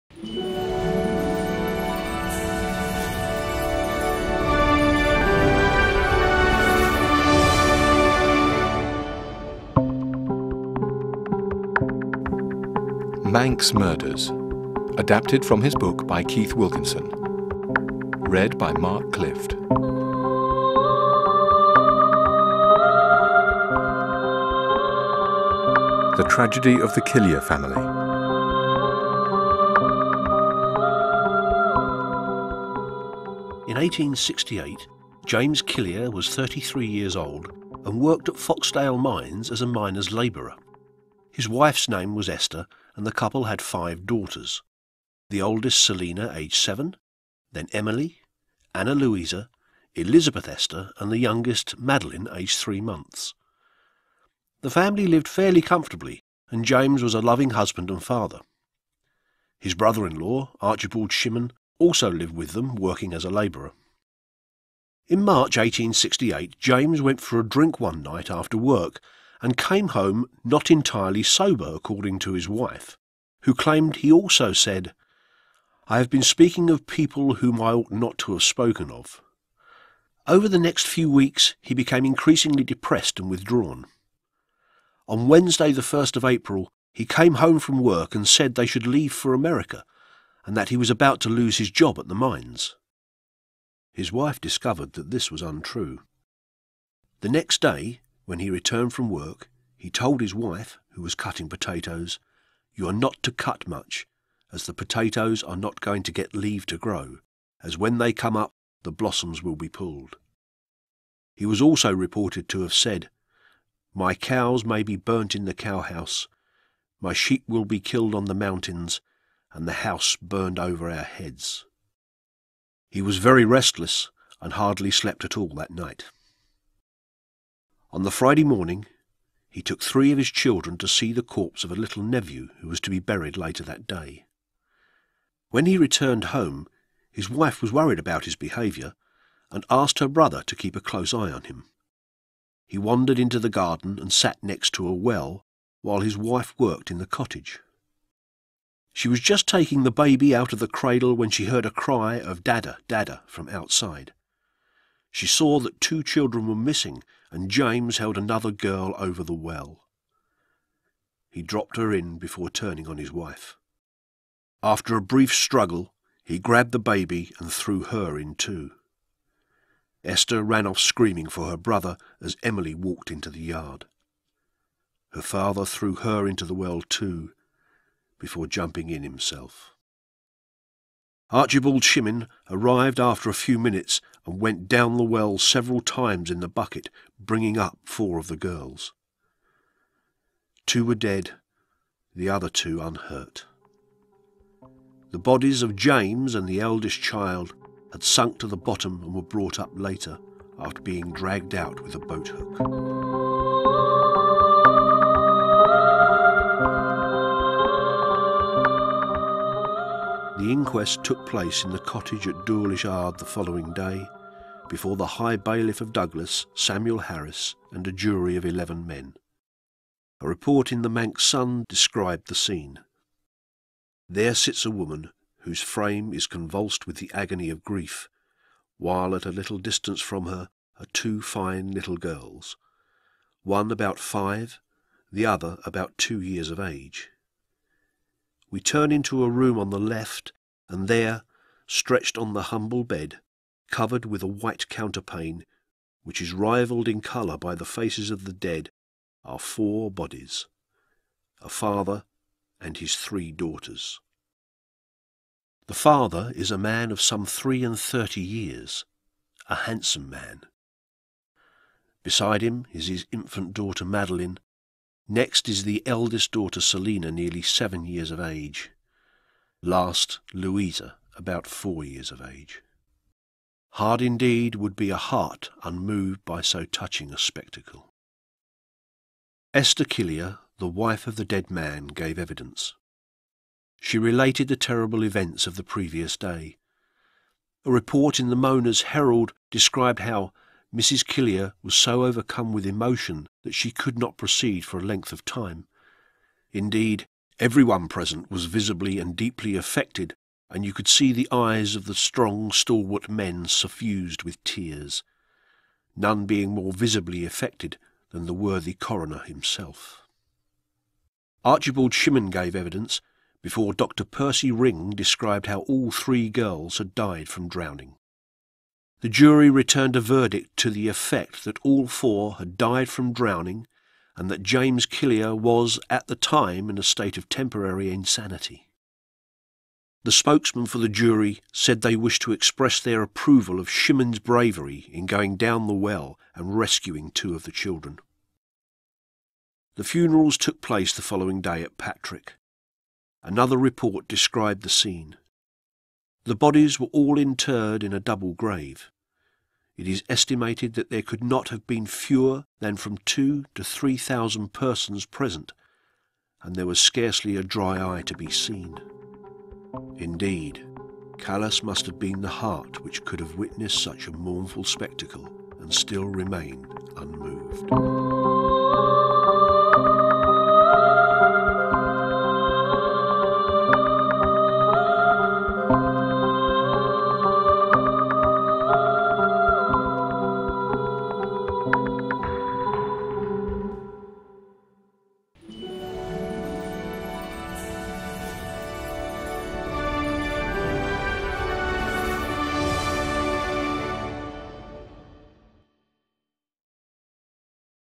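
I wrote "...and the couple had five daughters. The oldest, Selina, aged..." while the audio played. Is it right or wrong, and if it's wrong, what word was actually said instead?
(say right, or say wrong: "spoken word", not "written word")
right.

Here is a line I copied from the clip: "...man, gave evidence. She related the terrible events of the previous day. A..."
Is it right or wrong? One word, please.
right.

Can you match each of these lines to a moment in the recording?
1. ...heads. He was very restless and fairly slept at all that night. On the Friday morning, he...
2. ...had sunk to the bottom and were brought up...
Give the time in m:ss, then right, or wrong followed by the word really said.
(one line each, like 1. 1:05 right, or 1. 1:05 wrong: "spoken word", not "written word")
1. 2:01 wrong: "hardly", not "fairly"
2. 3:17 right.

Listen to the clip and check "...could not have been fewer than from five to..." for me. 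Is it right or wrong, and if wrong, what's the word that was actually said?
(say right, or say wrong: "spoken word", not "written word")
wrong: "two", not "five".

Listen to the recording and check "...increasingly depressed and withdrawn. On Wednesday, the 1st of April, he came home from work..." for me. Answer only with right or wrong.
right.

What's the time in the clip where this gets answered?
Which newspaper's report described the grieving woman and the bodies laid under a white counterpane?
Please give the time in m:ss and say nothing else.
3:40.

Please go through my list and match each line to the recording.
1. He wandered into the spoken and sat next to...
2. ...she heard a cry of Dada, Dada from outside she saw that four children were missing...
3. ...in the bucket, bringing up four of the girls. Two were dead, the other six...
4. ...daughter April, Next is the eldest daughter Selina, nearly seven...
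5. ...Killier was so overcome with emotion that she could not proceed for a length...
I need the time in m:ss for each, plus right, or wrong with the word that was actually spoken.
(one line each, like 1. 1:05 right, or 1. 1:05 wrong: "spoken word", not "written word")
1. 2:22 wrong: "garden", not "spoken"
2. 2:31 wrong: "two", not "four"
3. 3:06 wrong: "two", not "six"
4. 4:23 wrong: "Madeline", not "April"
5. 4:51 right.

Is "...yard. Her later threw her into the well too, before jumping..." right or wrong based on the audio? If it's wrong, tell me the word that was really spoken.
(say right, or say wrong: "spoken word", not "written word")
wrong: "father", not "later".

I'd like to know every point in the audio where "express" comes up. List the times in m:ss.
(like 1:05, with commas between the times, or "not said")
5:32.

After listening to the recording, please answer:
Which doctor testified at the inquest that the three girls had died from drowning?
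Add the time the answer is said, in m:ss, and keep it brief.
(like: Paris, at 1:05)
Dr. Percy Ring, at 5:13.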